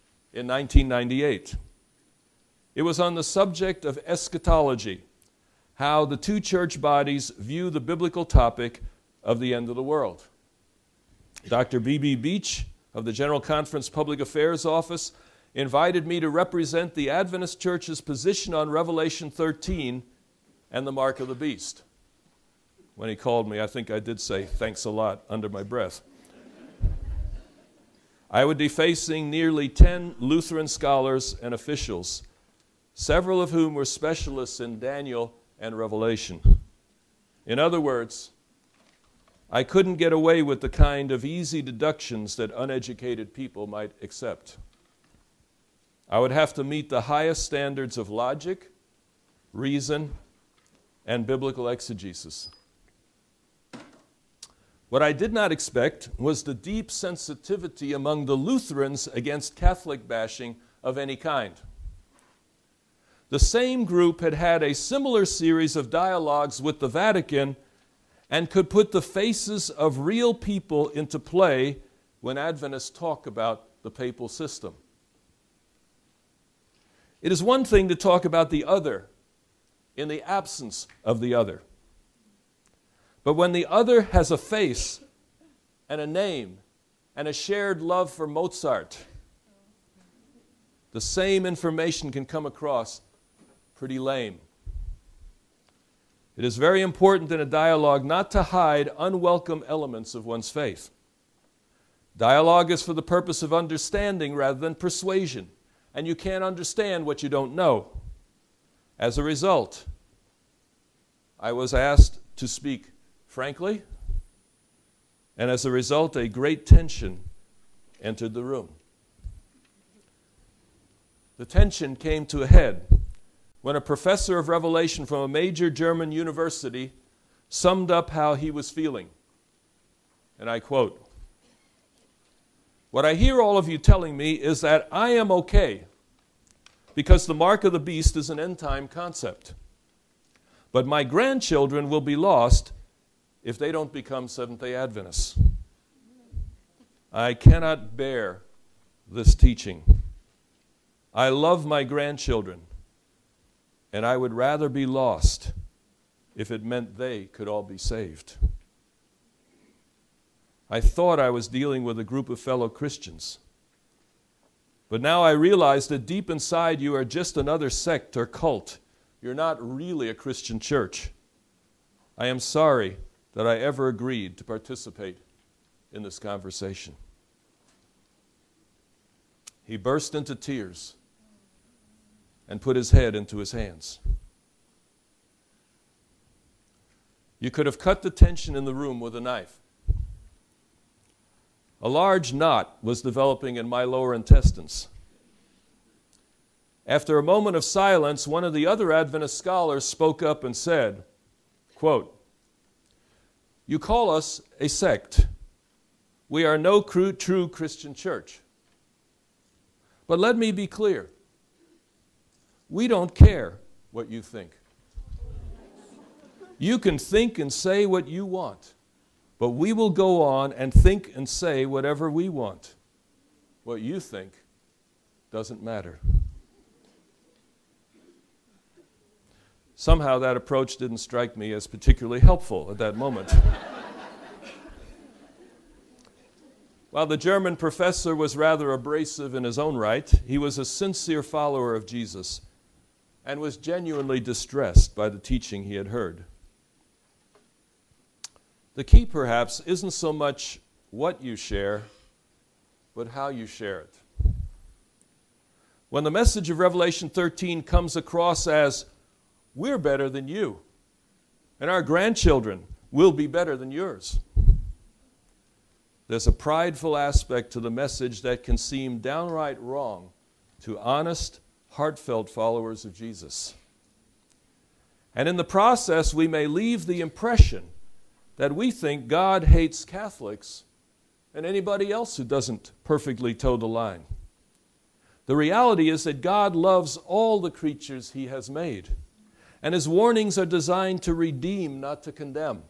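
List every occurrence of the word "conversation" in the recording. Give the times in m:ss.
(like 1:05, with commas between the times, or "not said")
2:56.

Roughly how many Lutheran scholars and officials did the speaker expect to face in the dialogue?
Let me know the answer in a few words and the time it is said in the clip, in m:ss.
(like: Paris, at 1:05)
nearly 10, at 0:29.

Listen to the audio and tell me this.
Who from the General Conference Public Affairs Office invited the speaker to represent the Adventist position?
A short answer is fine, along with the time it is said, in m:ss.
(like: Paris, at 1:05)
Dr. B.B. Beach, at 0:11.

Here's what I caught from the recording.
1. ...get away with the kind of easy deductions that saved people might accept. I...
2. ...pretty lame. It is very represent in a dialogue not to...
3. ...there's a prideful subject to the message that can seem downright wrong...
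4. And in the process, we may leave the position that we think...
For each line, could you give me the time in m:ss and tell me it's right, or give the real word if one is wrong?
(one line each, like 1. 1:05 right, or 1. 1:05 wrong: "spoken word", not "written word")
1. 0:39 wrong: "uneducated", not "saved"
2. 1:33 wrong: "important", not "represent"
3. 4:26 wrong: "aspect", not "subject"
4. 4:35 wrong: "impression", not "position".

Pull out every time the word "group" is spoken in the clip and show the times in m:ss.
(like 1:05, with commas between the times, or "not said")
1:03, 2:42.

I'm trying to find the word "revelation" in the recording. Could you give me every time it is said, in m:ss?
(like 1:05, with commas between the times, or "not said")
0:18, 0:35, 2:04, 4:16.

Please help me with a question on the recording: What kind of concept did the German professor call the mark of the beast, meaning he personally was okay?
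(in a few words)
An end time concept.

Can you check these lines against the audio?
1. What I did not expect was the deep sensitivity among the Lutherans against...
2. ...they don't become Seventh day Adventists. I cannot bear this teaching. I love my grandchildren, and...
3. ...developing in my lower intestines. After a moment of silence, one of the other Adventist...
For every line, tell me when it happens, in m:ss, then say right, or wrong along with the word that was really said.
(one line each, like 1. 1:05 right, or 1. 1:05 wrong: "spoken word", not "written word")
1. 0:54 right
2. 2:23 right
3. 3:13 right.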